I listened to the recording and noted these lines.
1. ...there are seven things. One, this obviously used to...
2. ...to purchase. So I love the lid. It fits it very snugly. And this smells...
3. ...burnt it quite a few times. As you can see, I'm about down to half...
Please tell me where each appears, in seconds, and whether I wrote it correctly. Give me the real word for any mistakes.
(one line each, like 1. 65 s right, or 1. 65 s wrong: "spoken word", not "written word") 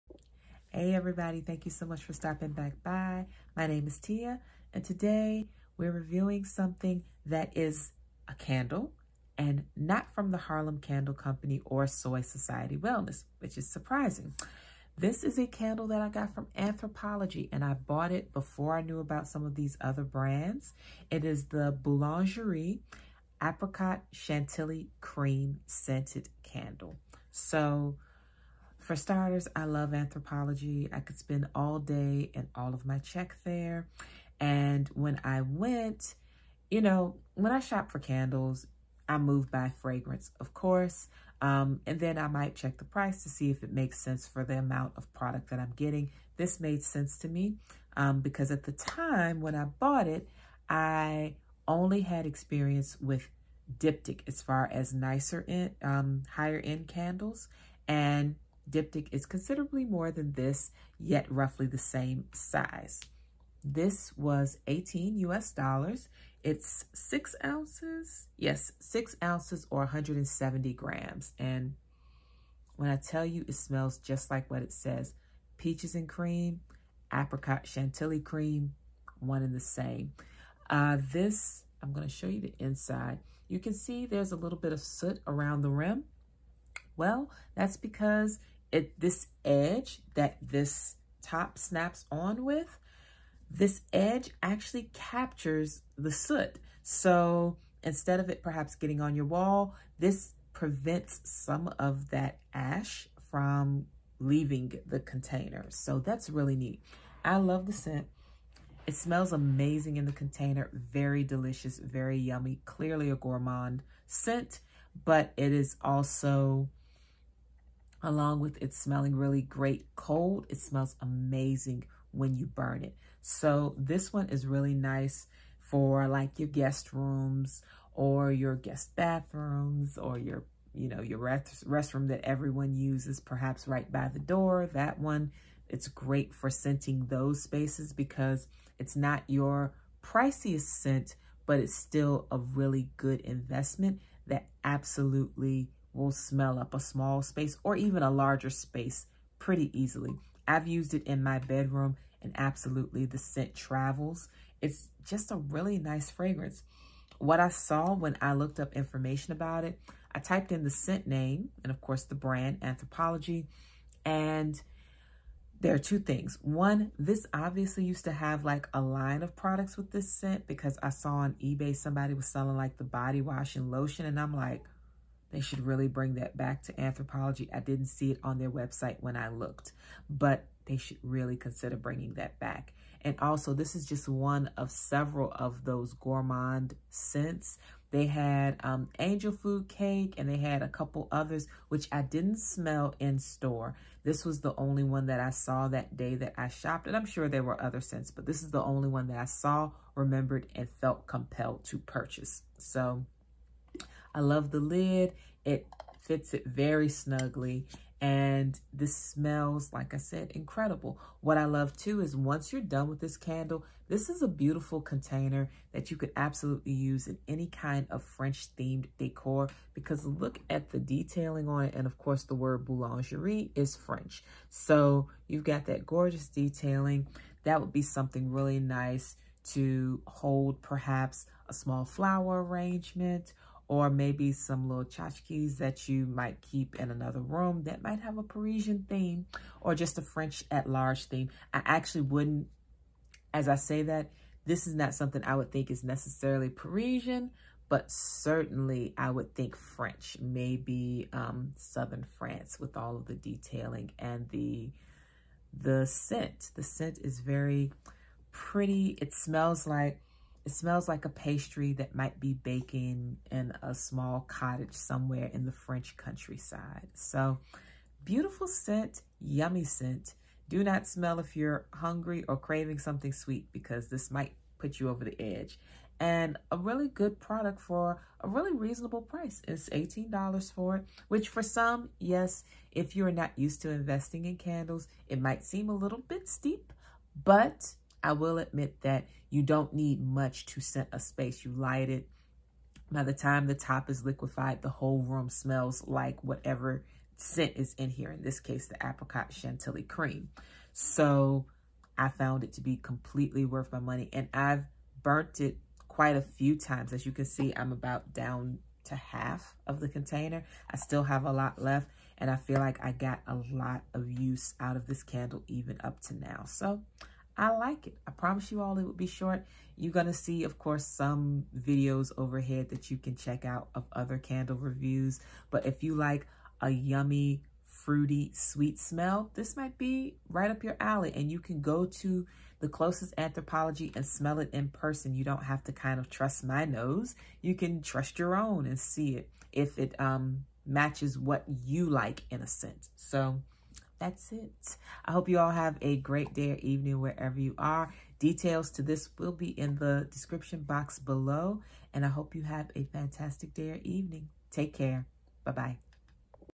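1. 165 s wrong: "two", not "seven"
2. 201 s right
3. 305 s right.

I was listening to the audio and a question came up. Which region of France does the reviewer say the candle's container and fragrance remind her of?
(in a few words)
Southern France.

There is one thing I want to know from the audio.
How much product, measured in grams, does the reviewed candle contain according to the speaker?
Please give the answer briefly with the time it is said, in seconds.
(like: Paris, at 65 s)
170 grams, at 69 s.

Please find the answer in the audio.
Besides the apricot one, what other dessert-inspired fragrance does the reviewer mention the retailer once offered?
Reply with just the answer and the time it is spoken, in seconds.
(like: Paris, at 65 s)
Angel food cake, at 188 s.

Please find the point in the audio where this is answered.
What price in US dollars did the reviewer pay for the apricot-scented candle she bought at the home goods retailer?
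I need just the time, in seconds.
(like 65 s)
64 s.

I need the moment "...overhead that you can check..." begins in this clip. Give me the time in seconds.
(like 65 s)
322 s.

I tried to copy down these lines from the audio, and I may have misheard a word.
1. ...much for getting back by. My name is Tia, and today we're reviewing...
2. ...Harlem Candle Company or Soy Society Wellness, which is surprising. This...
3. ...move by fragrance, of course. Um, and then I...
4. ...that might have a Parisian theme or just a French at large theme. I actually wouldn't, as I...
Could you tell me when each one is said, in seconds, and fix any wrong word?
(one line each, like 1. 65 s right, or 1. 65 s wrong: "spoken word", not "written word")
1. 1 s wrong: "stopping", not "getting"
2. 10 s right
3. 39 s right
4. 237 s right.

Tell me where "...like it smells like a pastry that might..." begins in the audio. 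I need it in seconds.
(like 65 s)
259 s.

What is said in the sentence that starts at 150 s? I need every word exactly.
I've used it in my bedroom and absolutely the scent travels.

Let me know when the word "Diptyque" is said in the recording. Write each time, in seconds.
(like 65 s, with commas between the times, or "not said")
53 s, 58 s.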